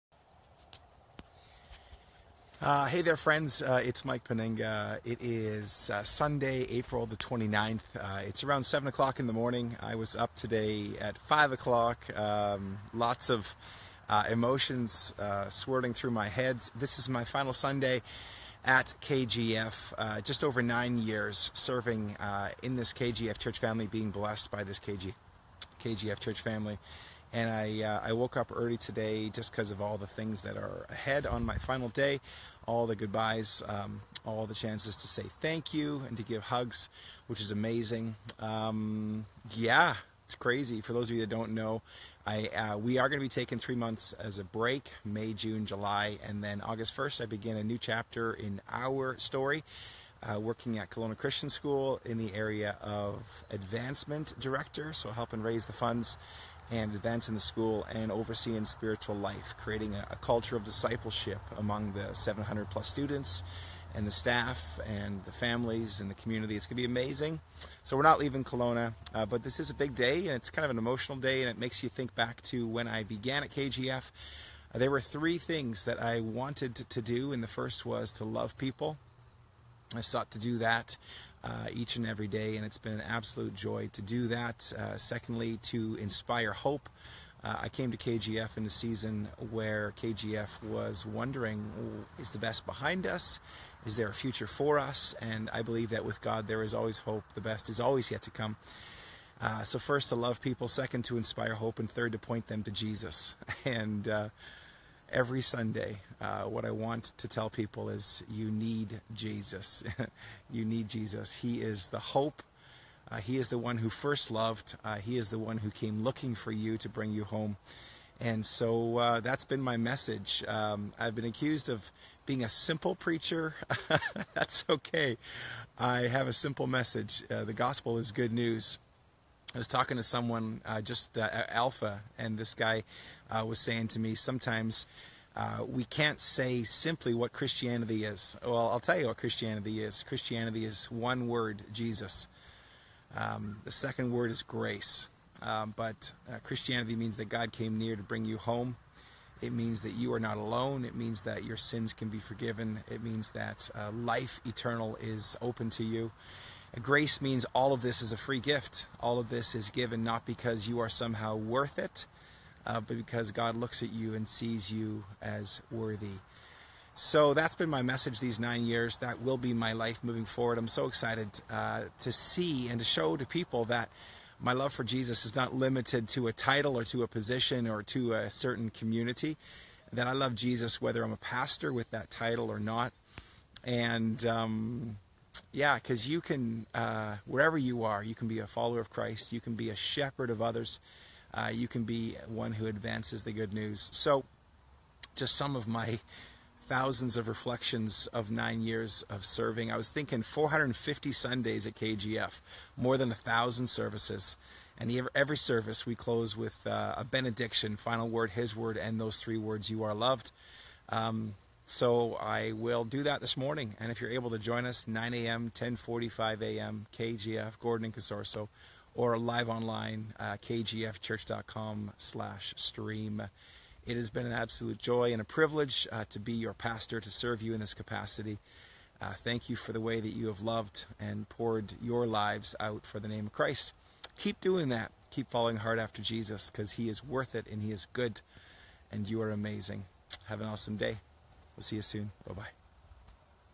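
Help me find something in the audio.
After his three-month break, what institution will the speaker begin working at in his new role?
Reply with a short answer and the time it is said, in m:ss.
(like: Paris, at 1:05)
Kelowna Christian School, at 0:50.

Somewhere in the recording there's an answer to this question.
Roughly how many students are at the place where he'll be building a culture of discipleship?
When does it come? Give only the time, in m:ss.
1:02.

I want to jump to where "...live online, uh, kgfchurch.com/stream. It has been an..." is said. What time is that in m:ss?
3:39.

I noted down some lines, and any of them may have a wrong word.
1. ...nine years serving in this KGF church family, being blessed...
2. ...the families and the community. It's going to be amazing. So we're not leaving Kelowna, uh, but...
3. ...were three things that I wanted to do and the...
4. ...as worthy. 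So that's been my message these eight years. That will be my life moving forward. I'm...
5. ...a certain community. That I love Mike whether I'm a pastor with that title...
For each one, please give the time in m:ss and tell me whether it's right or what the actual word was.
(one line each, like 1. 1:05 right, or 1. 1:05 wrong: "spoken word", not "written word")
1. 0:20 right
2. 1:05 right
3. 1:14 right
4. 2:45 wrong: "nine", not "eight"
5. 2:58 wrong: "Jesus", not "Mike".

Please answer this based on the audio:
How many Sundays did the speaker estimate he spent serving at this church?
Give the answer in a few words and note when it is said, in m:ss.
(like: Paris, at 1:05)
450, at 3:20.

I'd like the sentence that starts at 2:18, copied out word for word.
Well, I'll tell you what Christianity is.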